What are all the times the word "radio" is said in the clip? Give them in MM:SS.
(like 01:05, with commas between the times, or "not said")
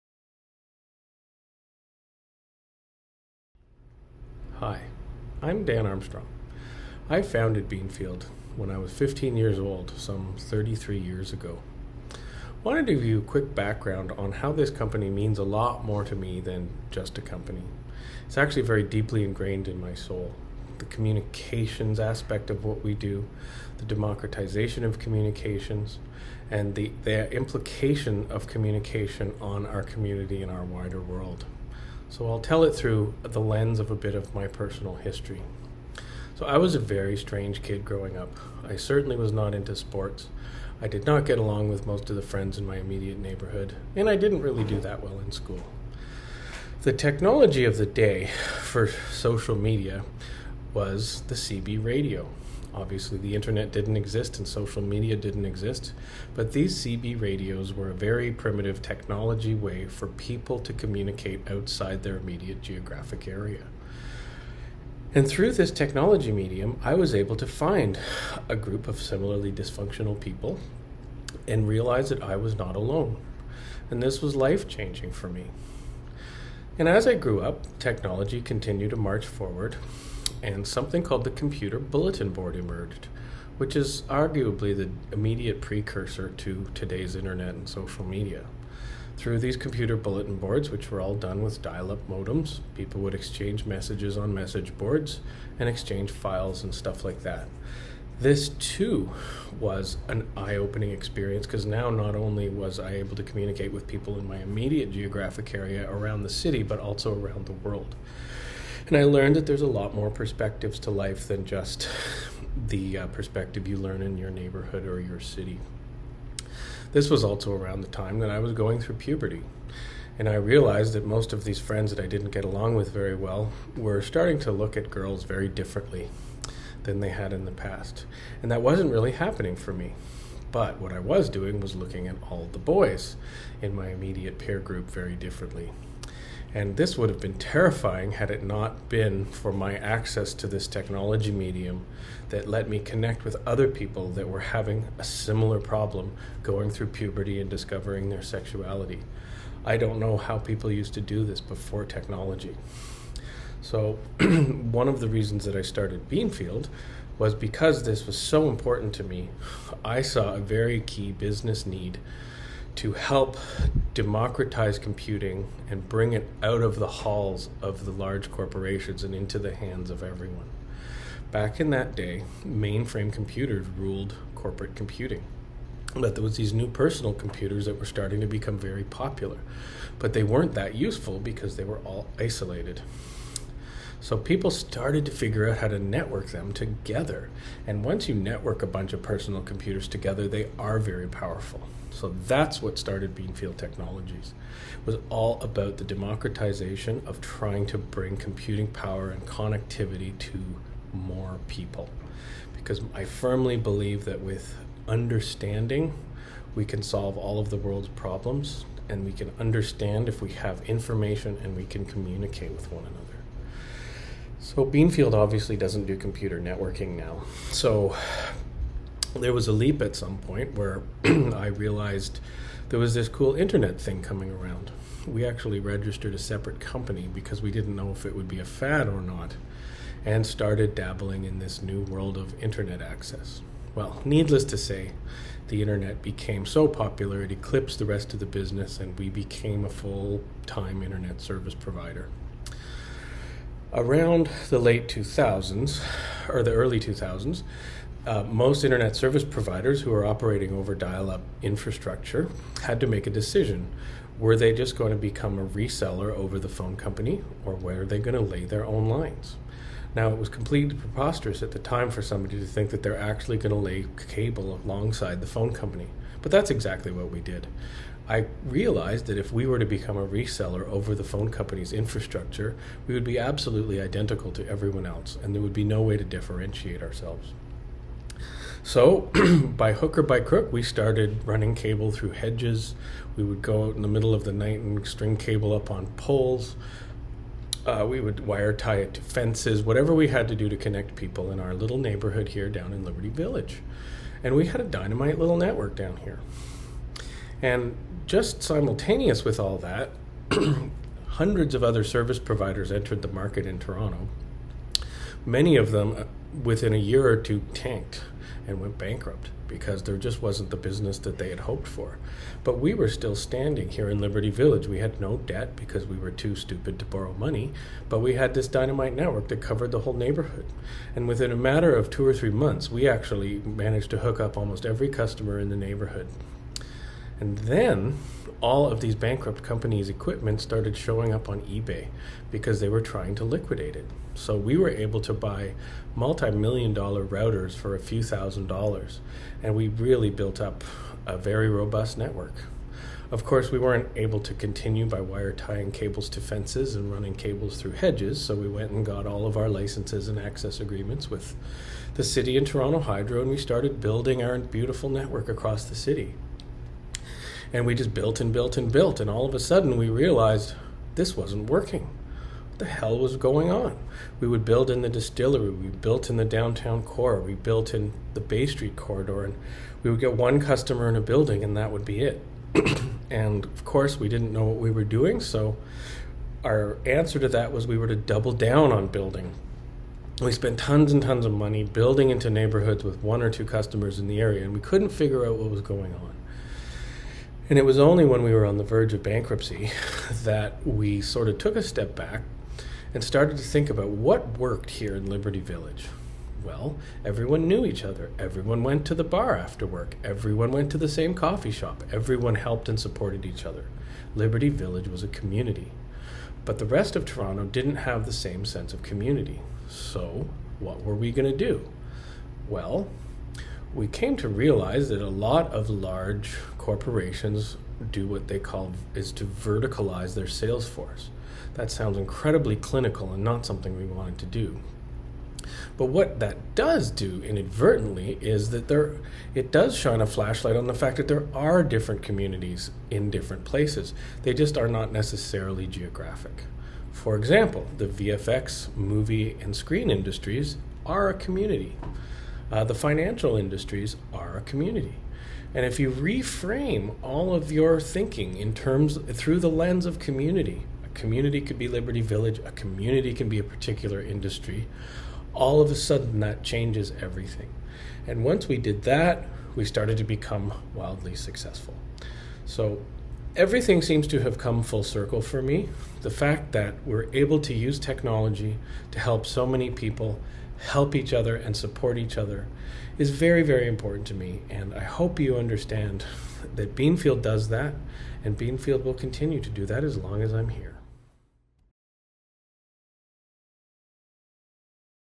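00:51, 00:57.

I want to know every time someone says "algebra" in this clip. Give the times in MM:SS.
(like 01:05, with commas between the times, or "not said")
not said.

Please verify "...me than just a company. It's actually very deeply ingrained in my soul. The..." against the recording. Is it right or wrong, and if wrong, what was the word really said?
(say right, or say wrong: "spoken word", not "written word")
right.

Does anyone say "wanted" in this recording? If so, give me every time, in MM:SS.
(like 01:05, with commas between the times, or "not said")
00:12, 07:03.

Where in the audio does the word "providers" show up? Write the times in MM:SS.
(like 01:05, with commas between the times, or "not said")
04:01, 04:09, 05:02.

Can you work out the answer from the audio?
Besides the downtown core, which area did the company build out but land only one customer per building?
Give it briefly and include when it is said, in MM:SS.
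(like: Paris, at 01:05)
the distillery, at 06:04.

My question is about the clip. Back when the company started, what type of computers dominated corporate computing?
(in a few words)
mainframe computers.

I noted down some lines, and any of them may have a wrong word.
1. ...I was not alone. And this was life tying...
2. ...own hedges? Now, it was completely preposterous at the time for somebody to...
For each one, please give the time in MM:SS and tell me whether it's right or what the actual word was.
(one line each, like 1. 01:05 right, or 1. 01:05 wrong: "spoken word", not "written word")
1. 01:12 wrong: "changing", not "tying"
2. 04:18 wrong: "lines", not "hedges".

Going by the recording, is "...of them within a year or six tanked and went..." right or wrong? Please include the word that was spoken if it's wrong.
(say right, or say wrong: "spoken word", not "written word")
wrong: "two", not "six".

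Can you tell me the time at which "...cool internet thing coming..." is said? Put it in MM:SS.
03:43.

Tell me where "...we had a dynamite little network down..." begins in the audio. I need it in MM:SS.
04:54.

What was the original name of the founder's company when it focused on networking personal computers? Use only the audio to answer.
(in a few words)
Beanfield Technologies.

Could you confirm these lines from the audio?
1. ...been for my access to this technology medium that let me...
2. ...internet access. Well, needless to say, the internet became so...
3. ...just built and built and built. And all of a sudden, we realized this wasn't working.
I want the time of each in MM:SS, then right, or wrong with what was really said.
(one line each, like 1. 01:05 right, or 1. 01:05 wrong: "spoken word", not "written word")
1. 02:18 right
2. 03:52 right
3. 05:57 right.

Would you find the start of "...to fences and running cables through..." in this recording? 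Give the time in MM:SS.
05:46.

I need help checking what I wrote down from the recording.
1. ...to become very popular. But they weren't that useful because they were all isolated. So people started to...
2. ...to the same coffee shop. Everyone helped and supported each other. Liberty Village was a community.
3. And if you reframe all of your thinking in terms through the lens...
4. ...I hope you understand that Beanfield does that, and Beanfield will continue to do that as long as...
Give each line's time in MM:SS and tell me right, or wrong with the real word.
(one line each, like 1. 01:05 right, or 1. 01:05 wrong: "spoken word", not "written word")
1. 02:58 right
2. 06:40 right
3. 07:25 right
4. 07:54 right.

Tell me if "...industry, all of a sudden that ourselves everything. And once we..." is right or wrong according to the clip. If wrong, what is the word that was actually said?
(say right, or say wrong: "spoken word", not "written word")
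wrong: "changes", not "ourselves".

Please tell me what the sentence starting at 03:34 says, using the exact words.
So Beanfield obviously doesn't do computer networking now.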